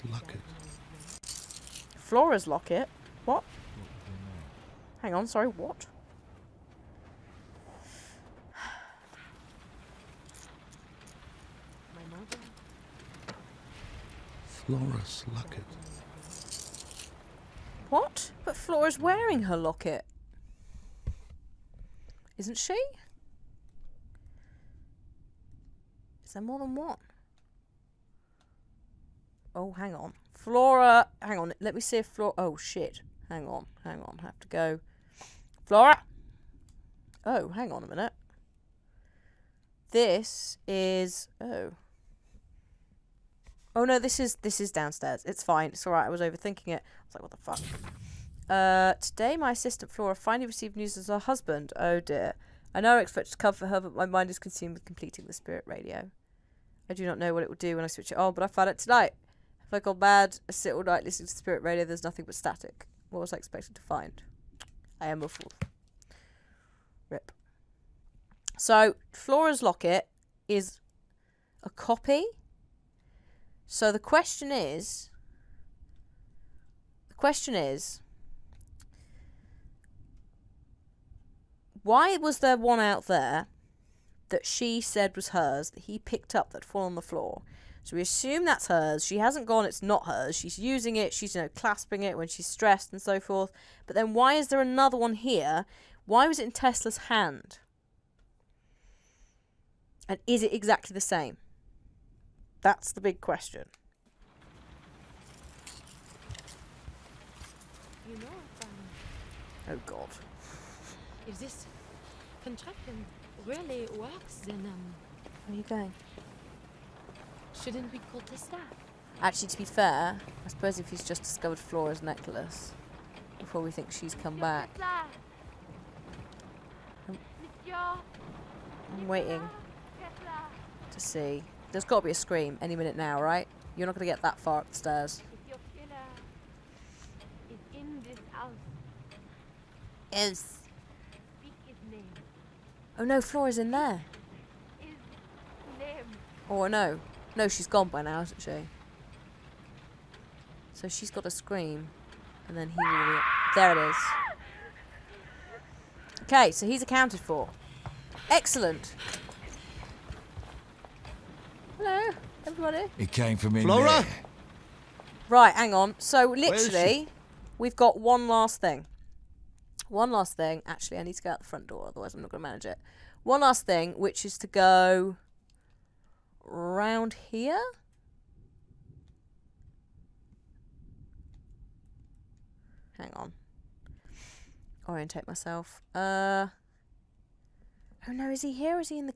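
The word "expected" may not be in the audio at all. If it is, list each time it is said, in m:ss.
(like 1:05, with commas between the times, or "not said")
0:53, 1:03.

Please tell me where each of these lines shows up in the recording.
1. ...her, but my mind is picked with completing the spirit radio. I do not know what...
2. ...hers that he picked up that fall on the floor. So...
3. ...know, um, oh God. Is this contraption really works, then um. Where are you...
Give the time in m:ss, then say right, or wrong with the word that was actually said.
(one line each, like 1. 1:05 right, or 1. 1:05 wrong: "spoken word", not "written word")
1. 0:53 wrong: "consumed", not "picked"
2. 1:25 right
3. 1:48 right.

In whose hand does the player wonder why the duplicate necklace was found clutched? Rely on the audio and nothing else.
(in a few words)
Tesla.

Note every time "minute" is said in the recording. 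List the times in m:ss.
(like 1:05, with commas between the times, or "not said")
0:37, 2:12.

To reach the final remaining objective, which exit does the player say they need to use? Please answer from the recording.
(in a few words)
the front door.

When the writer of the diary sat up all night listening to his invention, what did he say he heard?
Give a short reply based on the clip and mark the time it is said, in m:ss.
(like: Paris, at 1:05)
static, at 1:02.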